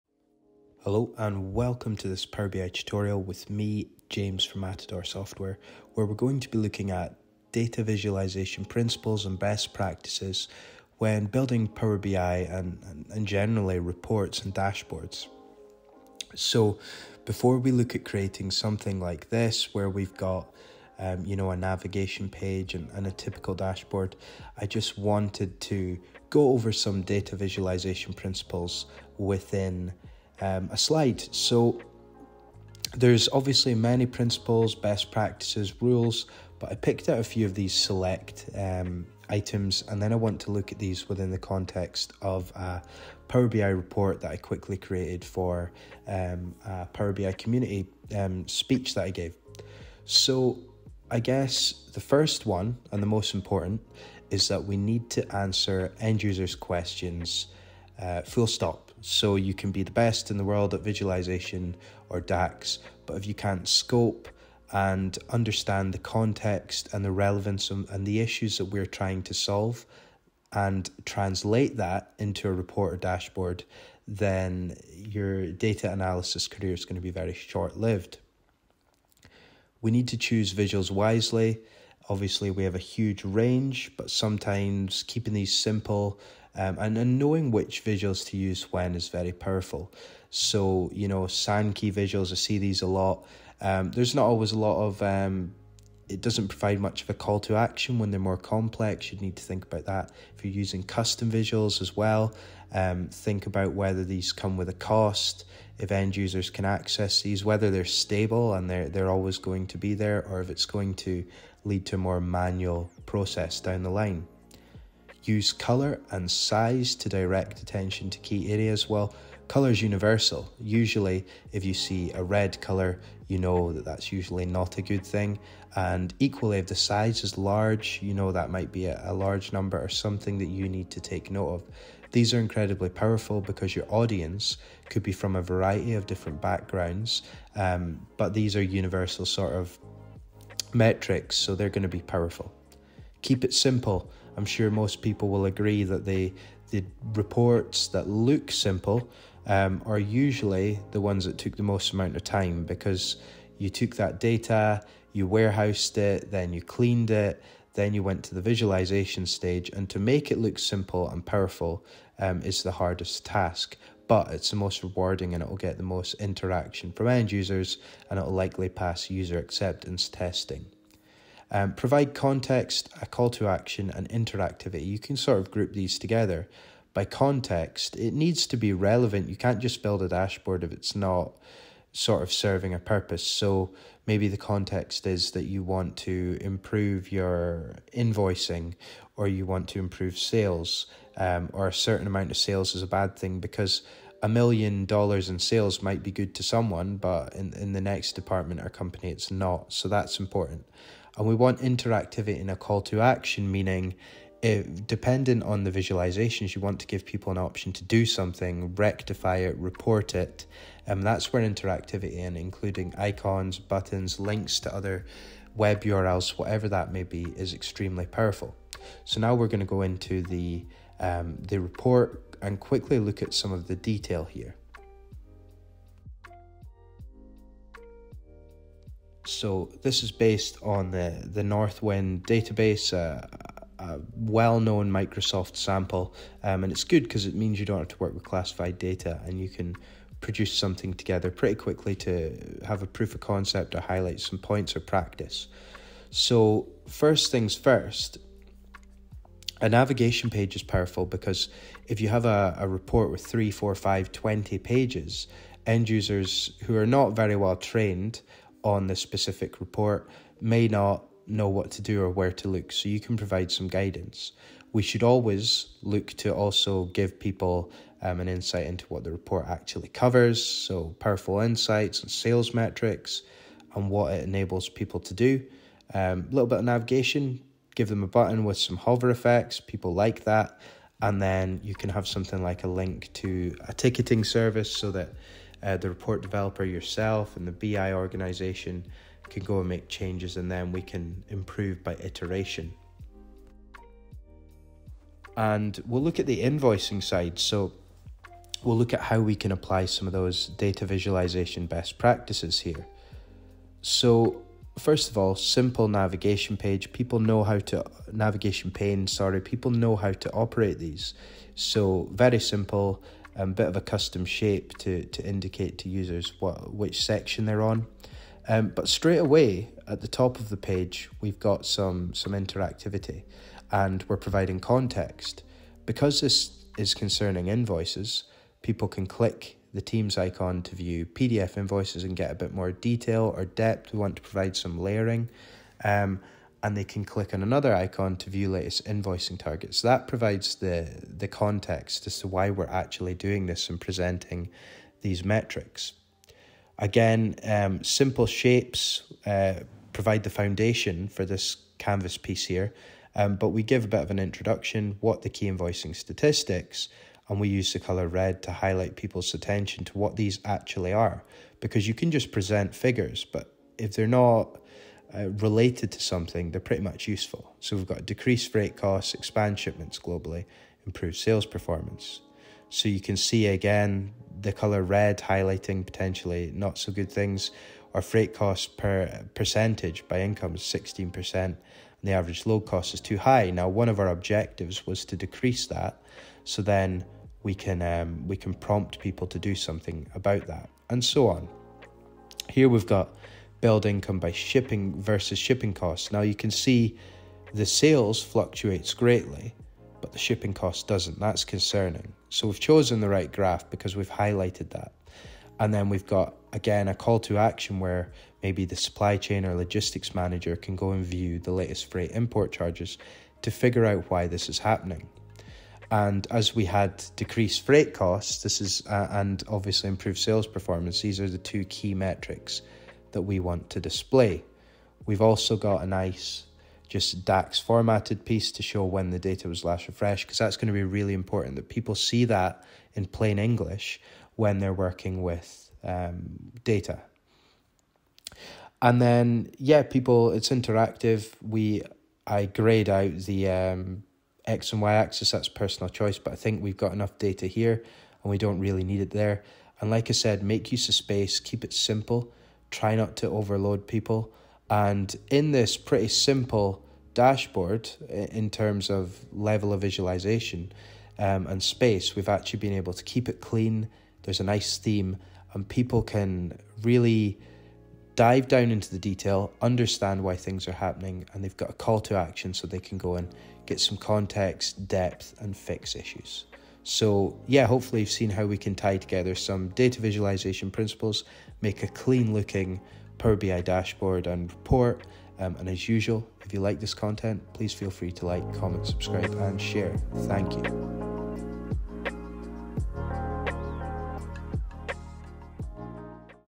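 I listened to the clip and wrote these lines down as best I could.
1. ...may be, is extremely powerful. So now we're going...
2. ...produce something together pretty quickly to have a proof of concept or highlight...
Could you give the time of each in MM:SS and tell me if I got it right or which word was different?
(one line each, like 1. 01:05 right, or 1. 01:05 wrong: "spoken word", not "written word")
1. 03:36 right
2. 04:00 right.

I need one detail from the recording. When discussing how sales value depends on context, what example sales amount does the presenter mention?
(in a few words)
a million dollars.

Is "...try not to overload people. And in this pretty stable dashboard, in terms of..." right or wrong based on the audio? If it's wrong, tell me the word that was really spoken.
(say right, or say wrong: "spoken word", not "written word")
wrong: "simple", not "stable".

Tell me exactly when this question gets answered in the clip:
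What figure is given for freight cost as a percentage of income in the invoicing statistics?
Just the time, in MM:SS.
06:20.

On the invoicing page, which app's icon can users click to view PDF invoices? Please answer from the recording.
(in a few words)
Teams.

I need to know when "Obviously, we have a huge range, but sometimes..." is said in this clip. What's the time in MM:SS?
01:22.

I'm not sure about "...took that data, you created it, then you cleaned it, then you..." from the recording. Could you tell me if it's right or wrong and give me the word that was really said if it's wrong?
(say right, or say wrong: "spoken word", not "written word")
wrong: "warehoused", not "created".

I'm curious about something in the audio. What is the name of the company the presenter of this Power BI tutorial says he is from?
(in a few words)
Matador Software.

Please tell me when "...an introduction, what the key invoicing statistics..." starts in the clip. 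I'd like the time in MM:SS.
05:54.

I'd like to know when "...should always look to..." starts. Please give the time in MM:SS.
04:24.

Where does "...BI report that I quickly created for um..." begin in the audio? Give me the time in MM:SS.
00:43.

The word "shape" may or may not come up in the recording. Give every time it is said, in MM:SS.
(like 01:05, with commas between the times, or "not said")
05:14, 05:48.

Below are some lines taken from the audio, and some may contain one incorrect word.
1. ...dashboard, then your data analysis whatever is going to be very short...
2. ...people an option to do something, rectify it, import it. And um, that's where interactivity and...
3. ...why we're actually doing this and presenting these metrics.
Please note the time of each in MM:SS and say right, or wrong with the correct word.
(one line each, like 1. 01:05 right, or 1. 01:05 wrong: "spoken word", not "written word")
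1. 01:12 wrong: "career", not "whatever"
2. 03:27 wrong: "report", not "import"
3. 05:42 right.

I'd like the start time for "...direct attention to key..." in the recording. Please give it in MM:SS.
01:57.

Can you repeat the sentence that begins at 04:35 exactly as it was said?
A um, little bit of navigation, give them a button with some hover effects, people like that.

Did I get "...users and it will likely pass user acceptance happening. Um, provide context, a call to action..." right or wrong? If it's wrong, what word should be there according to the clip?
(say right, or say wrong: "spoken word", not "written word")
wrong: "testing", not "happening".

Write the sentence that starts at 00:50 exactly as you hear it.
So I guess the first one and the most important is that we need to answer end users' questions uh, full stop.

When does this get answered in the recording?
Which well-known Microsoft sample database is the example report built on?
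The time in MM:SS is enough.
03:51.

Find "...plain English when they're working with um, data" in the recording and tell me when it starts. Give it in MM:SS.
07:13.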